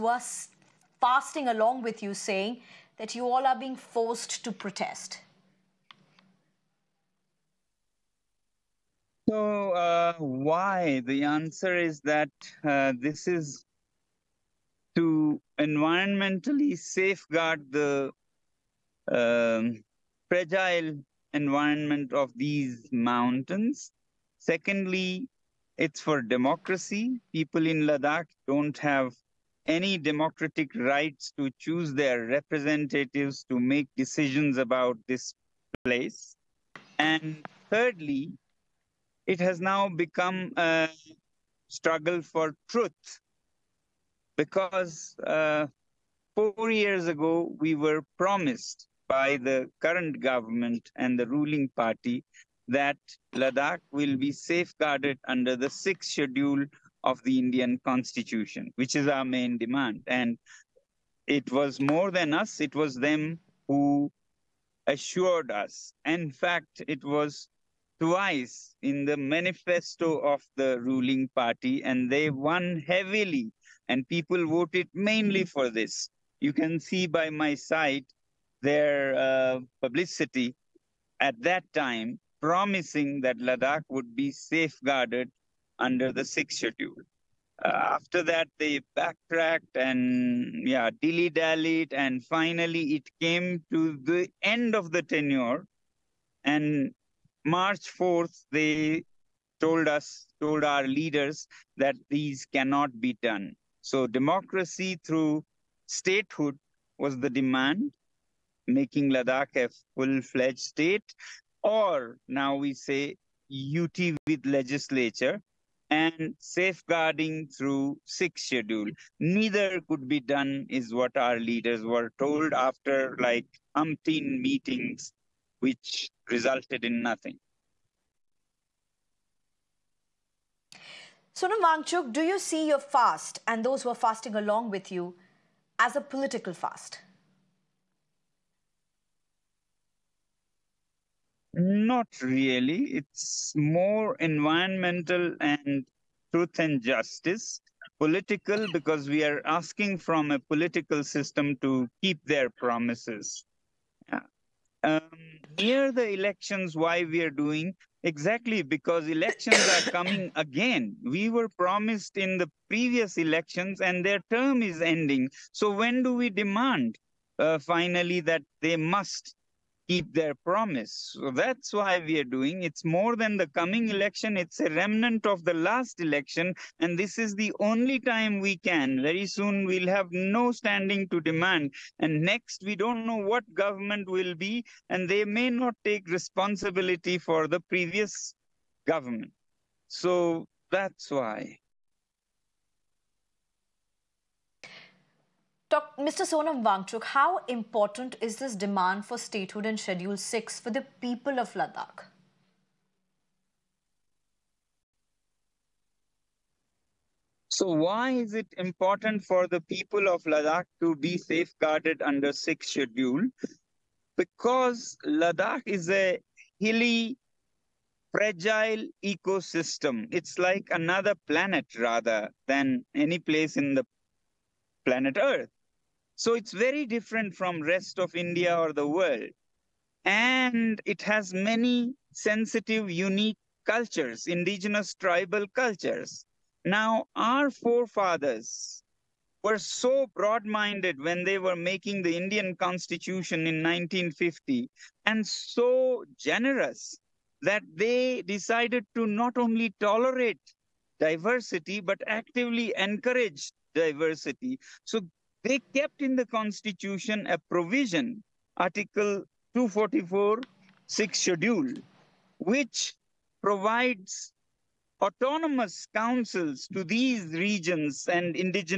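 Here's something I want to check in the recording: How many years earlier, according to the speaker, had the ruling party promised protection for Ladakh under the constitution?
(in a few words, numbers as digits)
4.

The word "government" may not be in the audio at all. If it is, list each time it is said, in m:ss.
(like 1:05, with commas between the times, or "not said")
0:50, 3:03, 3:08.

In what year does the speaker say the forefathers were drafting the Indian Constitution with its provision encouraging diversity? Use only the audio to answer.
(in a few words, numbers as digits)
1950.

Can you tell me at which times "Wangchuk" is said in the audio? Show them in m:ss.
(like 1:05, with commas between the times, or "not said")
2:11, 3:16.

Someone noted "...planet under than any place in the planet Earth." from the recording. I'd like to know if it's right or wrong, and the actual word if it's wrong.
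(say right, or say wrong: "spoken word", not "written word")
wrong: "rather", not "under".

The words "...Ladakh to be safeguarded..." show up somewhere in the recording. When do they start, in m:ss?
3:30.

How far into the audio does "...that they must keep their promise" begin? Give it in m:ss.
2:48.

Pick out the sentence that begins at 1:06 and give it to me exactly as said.
In fact, it was twice in the manifesto of the ruling party, and they won heavily, and people voted mainly for this.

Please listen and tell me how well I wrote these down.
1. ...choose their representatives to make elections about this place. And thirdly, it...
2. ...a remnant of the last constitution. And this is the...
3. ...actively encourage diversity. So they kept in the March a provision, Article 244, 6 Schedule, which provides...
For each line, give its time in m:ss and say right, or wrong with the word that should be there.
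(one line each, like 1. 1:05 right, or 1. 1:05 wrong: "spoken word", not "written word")
1. 0:31 wrong: "decisions", not "elections"
2. 2:54 wrong: "election", not "constitution"
3. 4:12 wrong: "Constitution", not "March".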